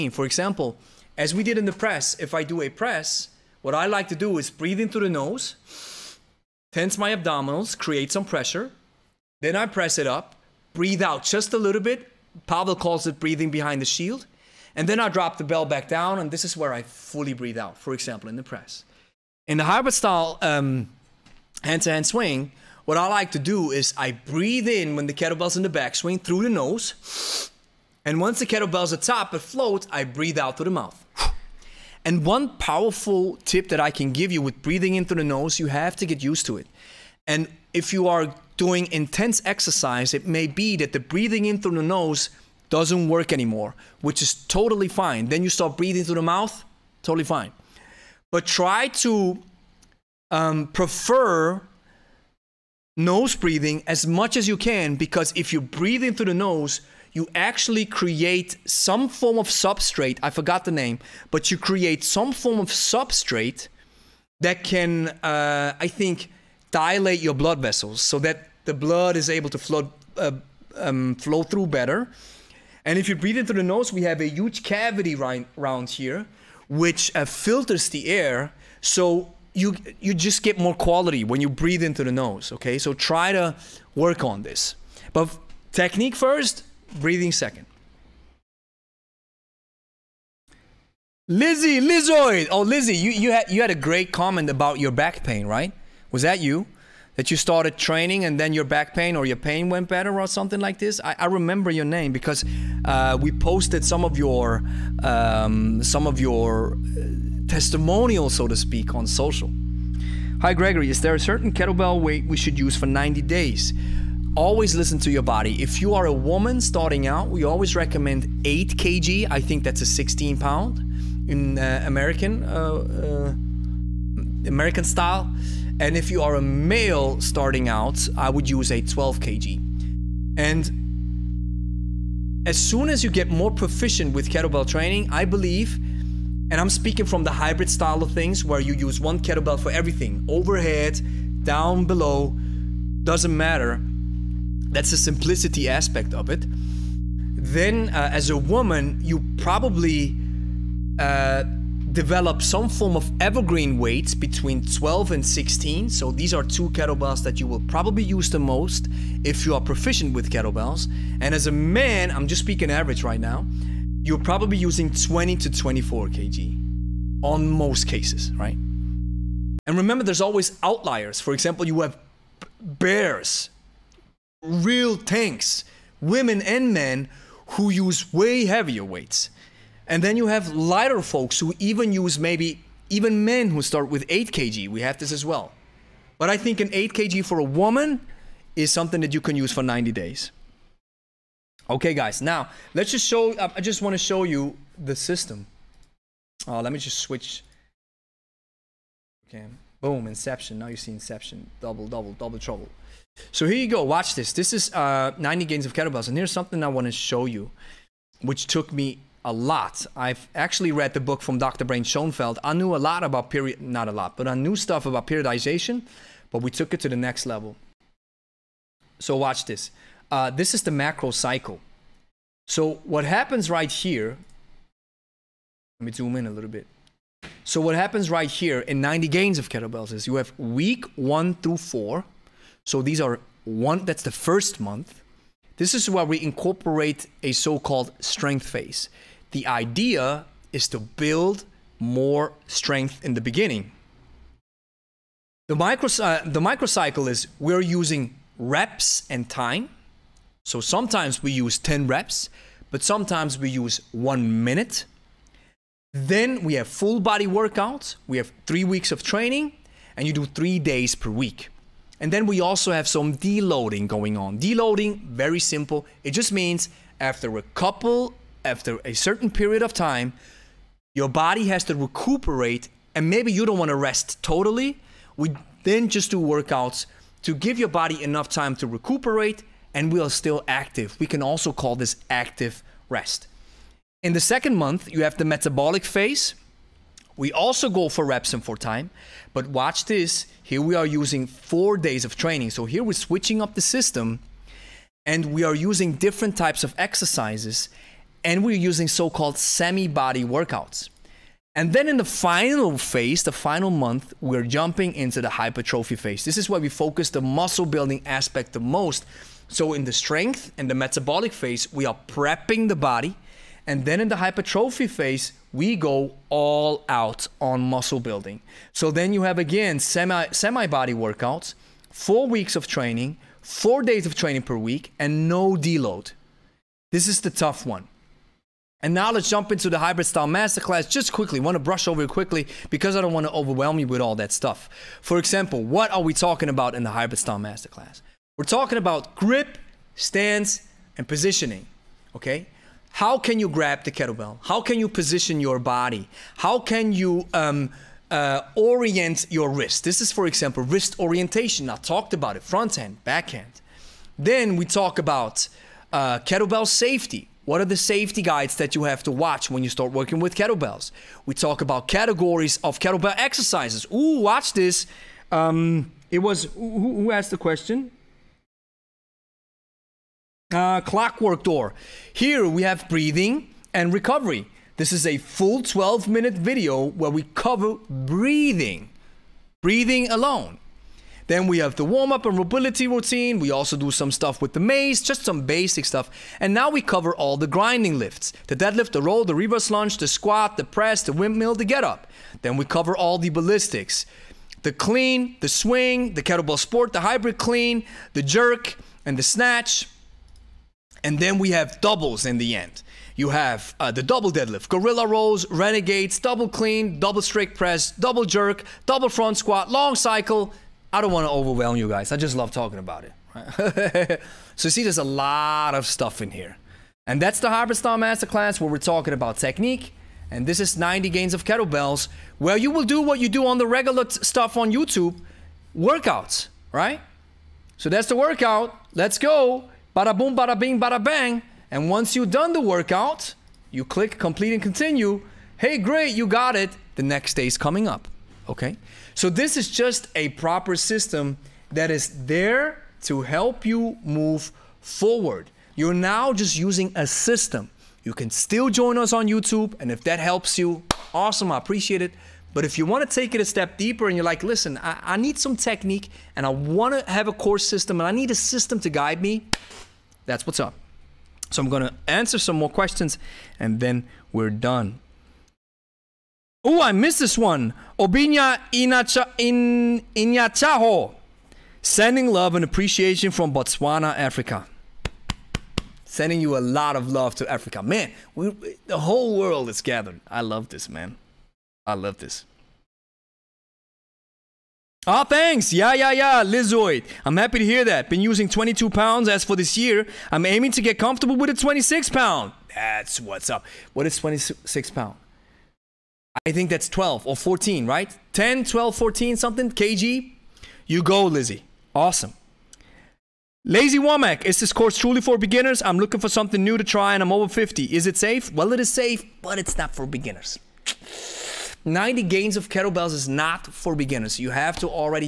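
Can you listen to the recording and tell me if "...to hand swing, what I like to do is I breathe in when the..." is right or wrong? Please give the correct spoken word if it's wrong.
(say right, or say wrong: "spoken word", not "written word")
right.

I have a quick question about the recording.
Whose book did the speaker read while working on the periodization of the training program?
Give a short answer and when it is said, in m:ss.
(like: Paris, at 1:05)
Dr. Brad Schoenfeld, at 3:31.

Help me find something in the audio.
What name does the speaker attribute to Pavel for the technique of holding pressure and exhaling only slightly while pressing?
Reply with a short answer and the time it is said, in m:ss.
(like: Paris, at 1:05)
breathing behind the shield, at 0:13.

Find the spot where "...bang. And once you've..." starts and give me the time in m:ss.
7:11.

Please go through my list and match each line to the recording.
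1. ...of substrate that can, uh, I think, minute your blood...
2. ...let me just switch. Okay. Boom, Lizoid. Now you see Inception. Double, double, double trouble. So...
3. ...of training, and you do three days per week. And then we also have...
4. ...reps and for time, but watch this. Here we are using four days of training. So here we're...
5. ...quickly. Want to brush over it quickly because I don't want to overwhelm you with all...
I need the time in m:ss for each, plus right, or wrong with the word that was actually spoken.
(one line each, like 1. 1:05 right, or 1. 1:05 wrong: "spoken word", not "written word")
1. 1:02 wrong: "dilate", not "minute"
2. 3:16 wrong: "Inception", not "Lizoid"
3. 4:18 right
4. 4:48 right
5. 5:31 right.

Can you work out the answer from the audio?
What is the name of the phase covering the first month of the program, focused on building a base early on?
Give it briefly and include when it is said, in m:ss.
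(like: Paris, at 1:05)
strength phase, at 3:57.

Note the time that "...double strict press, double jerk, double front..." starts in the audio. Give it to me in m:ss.
6:46.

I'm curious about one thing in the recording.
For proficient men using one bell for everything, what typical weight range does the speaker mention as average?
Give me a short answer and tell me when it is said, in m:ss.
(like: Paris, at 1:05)
20 to 24 kg, at 2:44.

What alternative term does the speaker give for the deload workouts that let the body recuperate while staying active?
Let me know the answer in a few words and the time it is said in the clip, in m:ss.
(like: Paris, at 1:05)
active rest, at 4:42.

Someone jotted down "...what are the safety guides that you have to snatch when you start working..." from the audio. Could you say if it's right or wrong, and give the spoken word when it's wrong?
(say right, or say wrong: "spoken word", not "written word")
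wrong: "watch", not "snatch".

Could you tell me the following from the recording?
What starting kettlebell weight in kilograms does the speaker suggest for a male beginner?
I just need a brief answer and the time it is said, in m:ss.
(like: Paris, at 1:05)
12 kg, at 2:08.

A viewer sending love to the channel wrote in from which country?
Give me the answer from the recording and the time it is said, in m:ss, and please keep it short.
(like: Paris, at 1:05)
Botswana, at 7:53.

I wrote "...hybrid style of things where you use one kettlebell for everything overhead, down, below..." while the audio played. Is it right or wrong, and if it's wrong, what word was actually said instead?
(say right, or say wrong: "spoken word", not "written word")
right.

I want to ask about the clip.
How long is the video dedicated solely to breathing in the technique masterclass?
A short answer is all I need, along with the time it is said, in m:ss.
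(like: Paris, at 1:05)
12 minutes, at 6:15.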